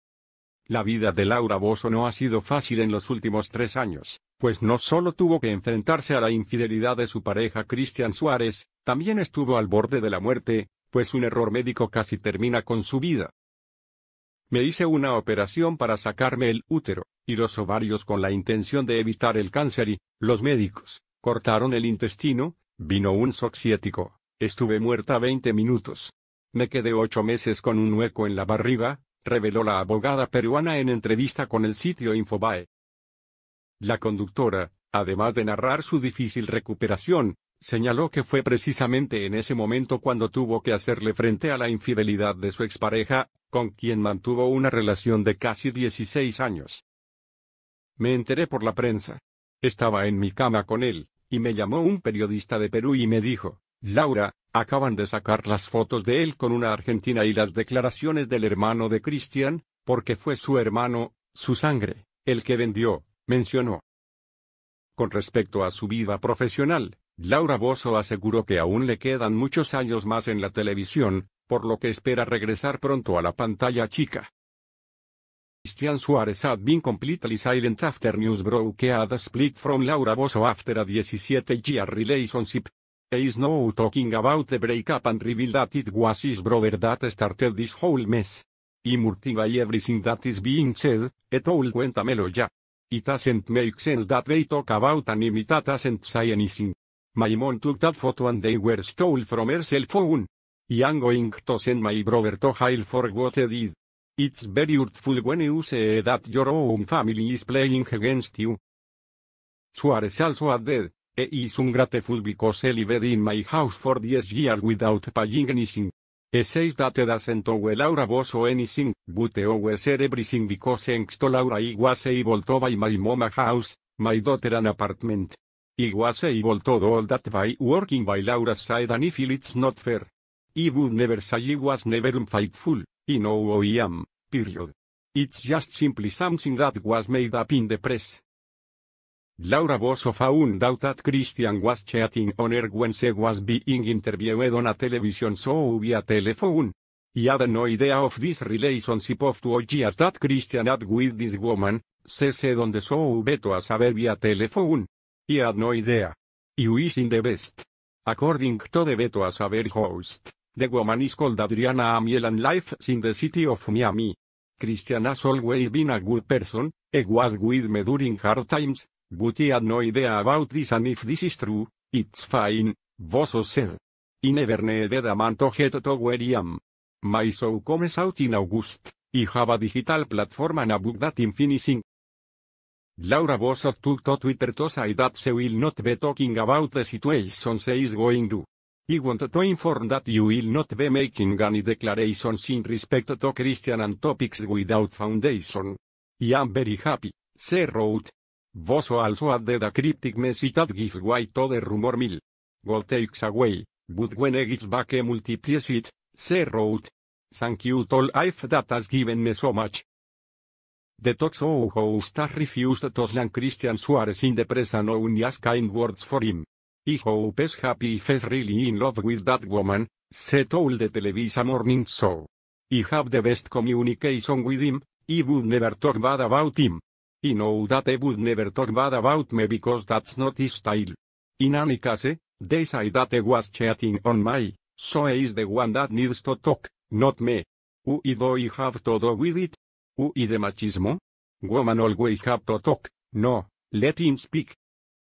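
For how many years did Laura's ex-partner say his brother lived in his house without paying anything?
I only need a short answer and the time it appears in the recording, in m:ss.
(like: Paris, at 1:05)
10 years, at 1:53.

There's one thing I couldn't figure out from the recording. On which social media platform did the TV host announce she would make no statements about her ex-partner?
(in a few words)
Twitter.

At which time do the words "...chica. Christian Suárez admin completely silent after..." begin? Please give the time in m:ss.
1:13.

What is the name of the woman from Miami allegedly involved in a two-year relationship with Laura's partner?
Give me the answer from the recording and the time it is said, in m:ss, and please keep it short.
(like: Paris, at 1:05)
Adriana Amiel, at 2:41.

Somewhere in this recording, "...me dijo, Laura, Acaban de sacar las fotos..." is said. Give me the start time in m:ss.
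0:53.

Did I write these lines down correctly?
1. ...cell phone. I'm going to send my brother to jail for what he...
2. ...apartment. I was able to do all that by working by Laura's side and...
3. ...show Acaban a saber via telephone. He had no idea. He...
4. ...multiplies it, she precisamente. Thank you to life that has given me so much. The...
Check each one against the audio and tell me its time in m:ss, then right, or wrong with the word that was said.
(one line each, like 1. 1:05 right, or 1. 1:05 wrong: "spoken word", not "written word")
1. 1:39 right
2. 2:04 right
3. 2:32 wrong: "Beto", not "Acaban"
4. 3:25 wrong: "wrote", not "precisamente".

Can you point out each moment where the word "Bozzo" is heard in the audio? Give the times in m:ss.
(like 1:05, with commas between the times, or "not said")
1:58, 2:19, 2:52, 3:03, 3:18.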